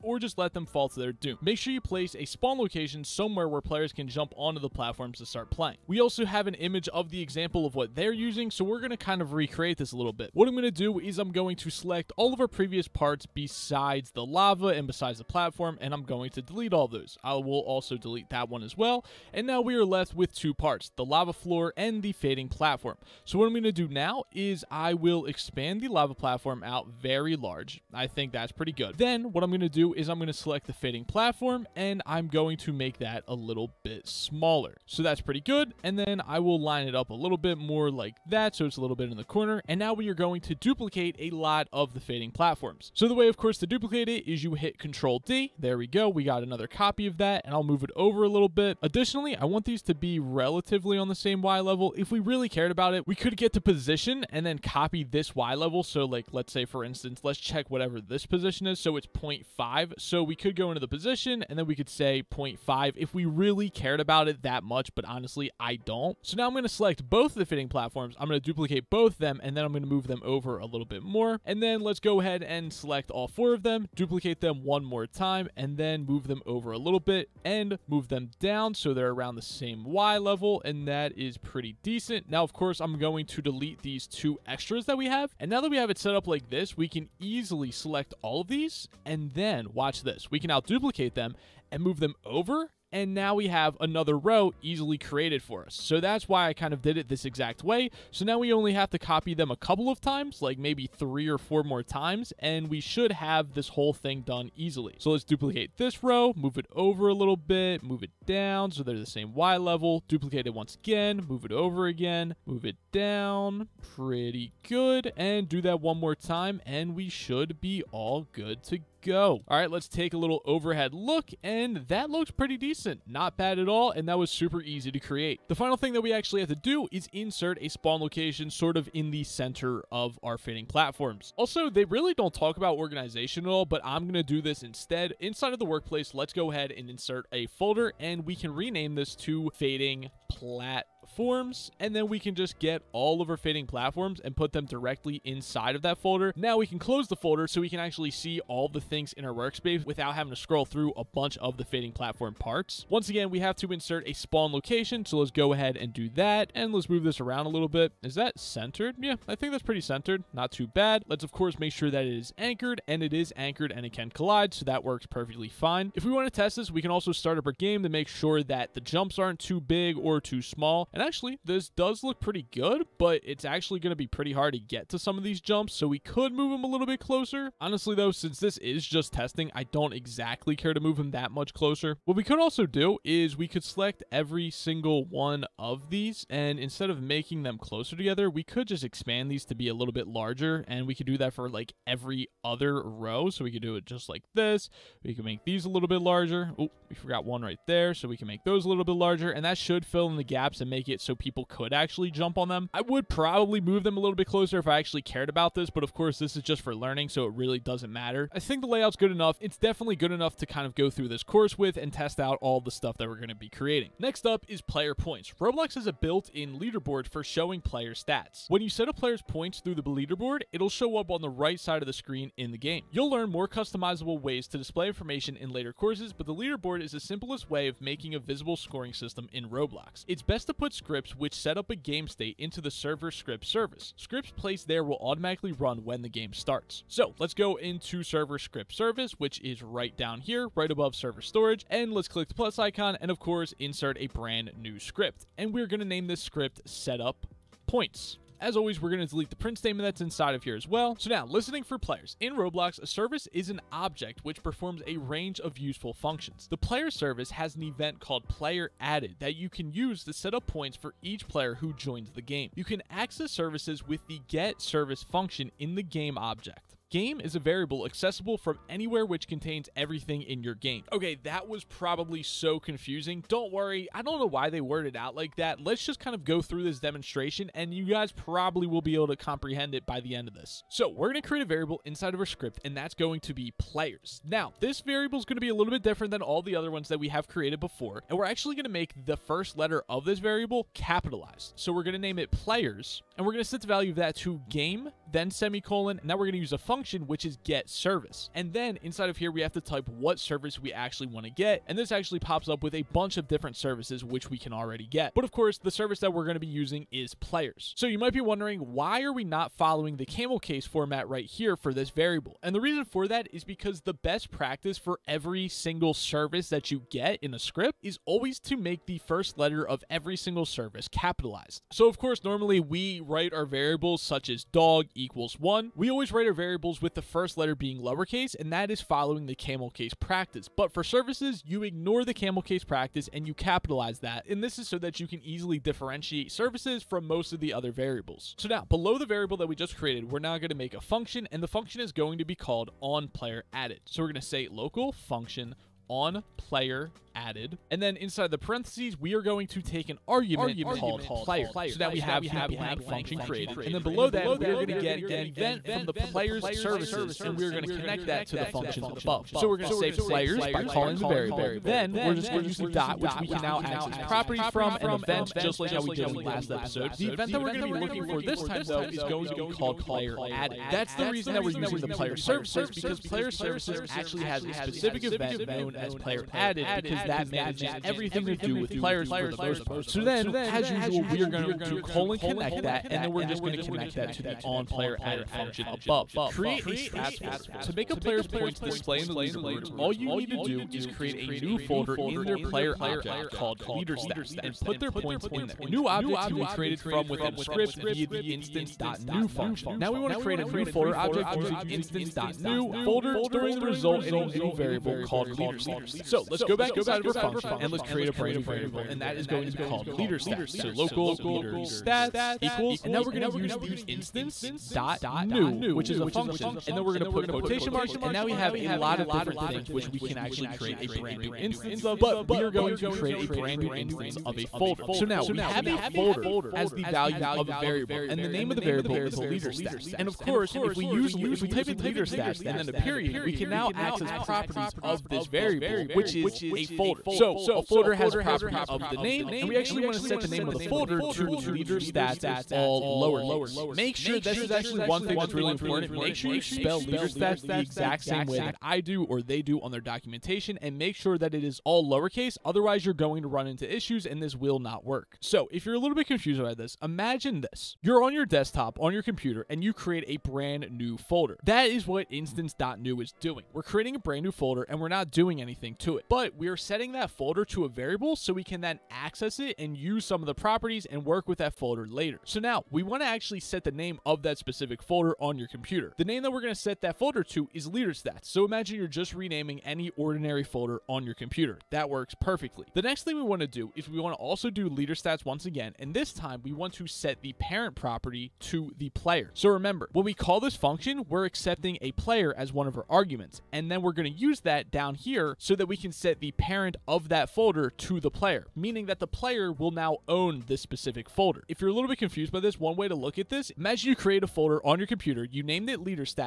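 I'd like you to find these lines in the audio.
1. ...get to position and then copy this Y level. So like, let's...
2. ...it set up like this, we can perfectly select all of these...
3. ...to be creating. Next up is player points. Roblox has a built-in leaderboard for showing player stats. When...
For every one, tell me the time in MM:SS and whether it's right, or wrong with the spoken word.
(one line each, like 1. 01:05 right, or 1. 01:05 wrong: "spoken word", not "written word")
1. 00:53 right
2. 01:25 wrong: "easily", not "perfectly"
3. 03:33 right.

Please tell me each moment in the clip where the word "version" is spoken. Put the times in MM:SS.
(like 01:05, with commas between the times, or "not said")
not said.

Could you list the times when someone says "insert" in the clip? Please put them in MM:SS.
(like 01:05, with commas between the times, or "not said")
02:07, 02:16, 02:33, 04:03.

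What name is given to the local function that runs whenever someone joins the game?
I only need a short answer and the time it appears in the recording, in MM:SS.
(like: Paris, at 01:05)
onPlayerAdded, at 05:42.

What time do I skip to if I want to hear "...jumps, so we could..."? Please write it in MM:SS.
02:55.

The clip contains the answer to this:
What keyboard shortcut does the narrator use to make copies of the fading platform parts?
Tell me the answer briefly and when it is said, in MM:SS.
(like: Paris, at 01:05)
Control D, at 00:44.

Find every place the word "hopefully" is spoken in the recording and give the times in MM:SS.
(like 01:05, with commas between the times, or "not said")
not said.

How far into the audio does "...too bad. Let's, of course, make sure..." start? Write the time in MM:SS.
02:40.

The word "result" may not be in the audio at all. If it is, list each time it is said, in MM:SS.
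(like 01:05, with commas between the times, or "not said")
06:43.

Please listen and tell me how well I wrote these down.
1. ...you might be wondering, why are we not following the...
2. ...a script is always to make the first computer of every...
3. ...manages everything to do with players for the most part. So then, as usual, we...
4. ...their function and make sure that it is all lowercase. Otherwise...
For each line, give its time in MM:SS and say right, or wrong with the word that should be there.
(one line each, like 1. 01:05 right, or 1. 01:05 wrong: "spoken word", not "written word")
1. 05:07 right
2. 05:17 wrong: "letter", not "computer"
3. 06:17 right
4. 07:29 wrong: "documentation", not "function".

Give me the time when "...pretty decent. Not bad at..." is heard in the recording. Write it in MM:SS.
02:02.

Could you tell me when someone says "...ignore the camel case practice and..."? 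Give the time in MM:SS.
05:31.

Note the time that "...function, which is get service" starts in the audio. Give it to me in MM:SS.
04:56.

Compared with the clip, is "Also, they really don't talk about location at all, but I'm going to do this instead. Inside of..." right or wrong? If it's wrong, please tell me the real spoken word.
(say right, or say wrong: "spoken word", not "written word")
wrong: "organization", not "location".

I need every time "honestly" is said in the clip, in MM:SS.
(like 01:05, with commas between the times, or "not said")
01:05, 02:57.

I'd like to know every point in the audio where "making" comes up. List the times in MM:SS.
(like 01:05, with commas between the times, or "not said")
03:07, 03:47.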